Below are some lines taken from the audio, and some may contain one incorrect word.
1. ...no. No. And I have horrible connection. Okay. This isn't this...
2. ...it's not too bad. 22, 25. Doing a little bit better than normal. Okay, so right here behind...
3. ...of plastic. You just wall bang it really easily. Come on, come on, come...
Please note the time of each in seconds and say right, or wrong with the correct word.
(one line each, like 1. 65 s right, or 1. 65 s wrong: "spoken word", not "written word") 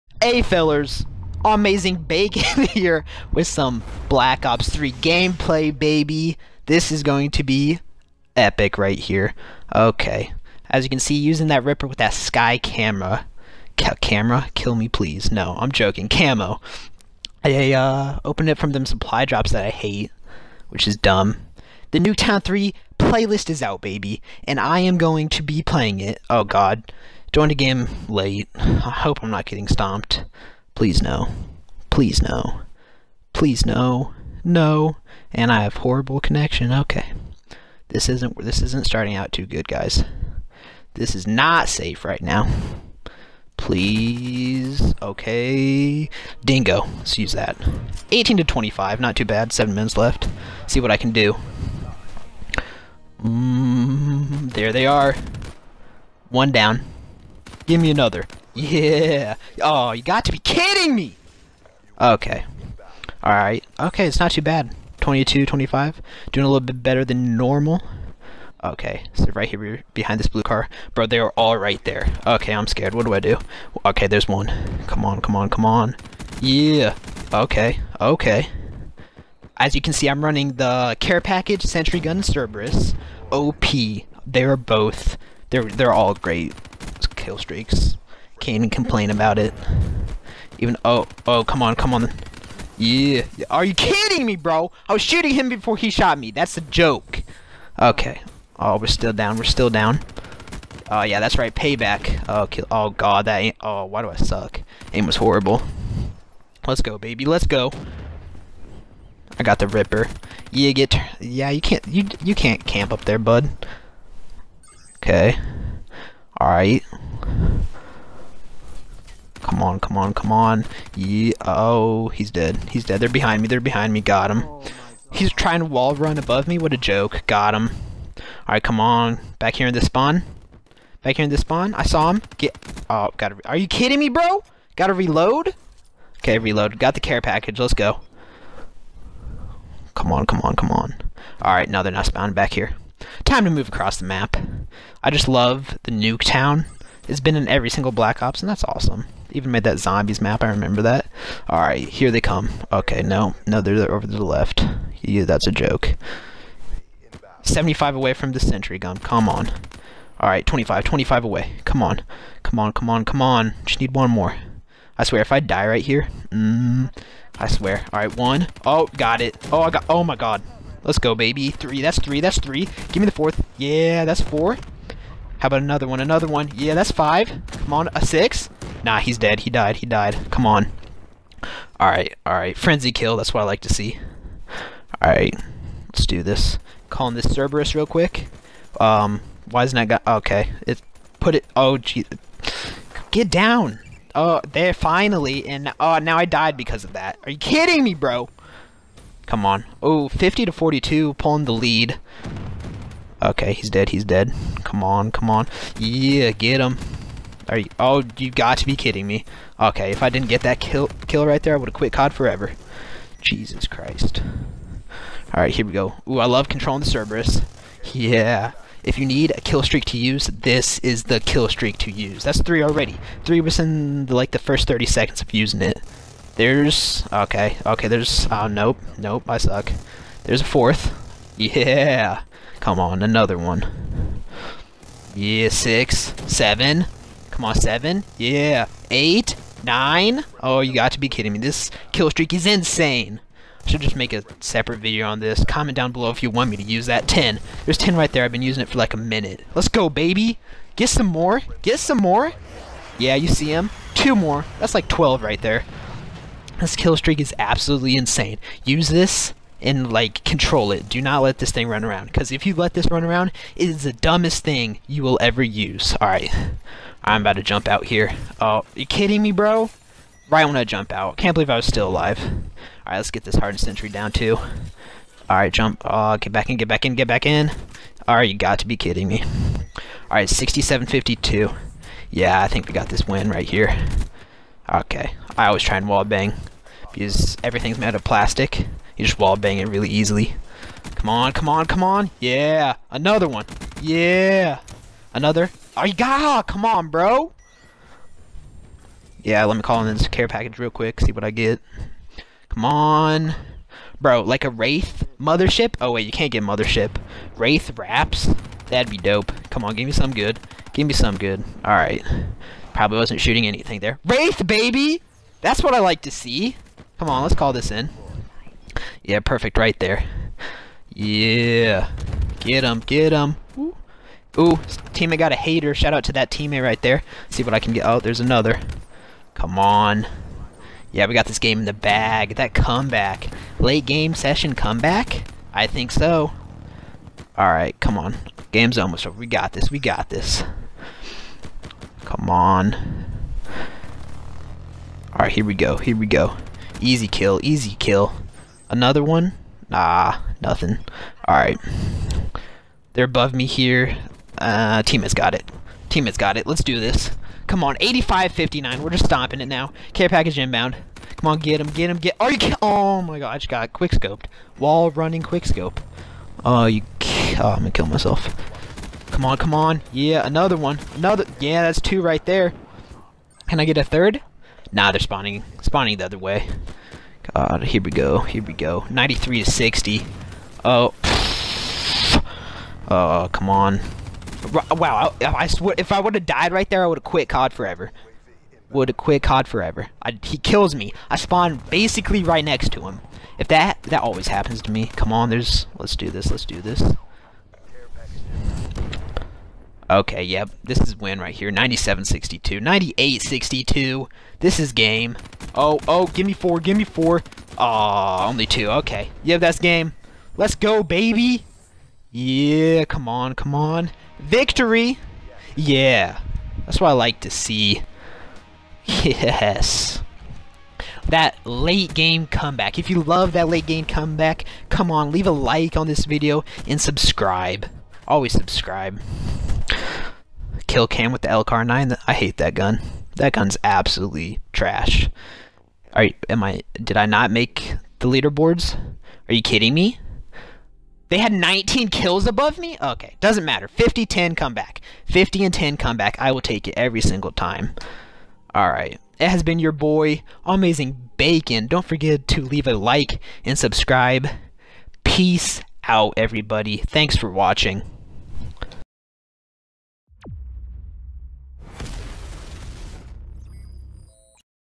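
1. 33 s right
2. 64 s right
3. 287 s right.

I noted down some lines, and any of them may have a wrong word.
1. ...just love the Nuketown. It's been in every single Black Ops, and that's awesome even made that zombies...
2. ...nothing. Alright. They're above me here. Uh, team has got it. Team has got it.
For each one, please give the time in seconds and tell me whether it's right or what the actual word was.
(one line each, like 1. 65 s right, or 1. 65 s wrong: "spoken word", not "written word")
1. 145 s right
2. 350 s right.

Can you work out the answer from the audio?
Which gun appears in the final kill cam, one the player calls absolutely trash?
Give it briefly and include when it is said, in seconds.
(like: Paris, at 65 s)
L-CAR 9, at 431 s.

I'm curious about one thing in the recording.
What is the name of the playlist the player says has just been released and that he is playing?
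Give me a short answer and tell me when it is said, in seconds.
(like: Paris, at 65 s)
Nuketown 3, at 21 s.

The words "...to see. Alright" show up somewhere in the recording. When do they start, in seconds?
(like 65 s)
183 s.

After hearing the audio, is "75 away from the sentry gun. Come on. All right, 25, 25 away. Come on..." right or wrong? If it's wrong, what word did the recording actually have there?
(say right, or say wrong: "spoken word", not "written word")
right.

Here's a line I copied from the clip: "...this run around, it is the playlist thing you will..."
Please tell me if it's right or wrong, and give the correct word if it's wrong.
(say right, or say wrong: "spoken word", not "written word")
wrong: "dumbest", not "playlist".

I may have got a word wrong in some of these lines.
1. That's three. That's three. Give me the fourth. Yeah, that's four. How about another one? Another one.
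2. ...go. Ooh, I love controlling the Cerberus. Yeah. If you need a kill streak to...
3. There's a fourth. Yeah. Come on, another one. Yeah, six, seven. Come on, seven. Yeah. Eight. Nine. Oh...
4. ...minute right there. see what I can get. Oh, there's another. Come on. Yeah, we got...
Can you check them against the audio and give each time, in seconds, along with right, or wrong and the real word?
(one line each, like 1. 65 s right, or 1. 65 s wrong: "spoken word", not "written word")
1. 171 s right
2. 215 s right
3. 230 s right
4. 326 s wrong: "teammate", not "minute".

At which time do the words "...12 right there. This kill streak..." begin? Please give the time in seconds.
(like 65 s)
254 s.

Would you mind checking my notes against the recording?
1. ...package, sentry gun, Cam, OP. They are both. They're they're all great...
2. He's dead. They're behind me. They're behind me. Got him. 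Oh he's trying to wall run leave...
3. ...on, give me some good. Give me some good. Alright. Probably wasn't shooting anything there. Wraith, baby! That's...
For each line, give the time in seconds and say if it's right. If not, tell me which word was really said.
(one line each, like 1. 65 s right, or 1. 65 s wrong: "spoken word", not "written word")
1. 81 s wrong: "Cerberus", not "Cam"
2. 122 s wrong: "above", not "leave"
3. 309 s right.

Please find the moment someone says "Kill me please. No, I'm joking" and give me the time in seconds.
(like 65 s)
14 s.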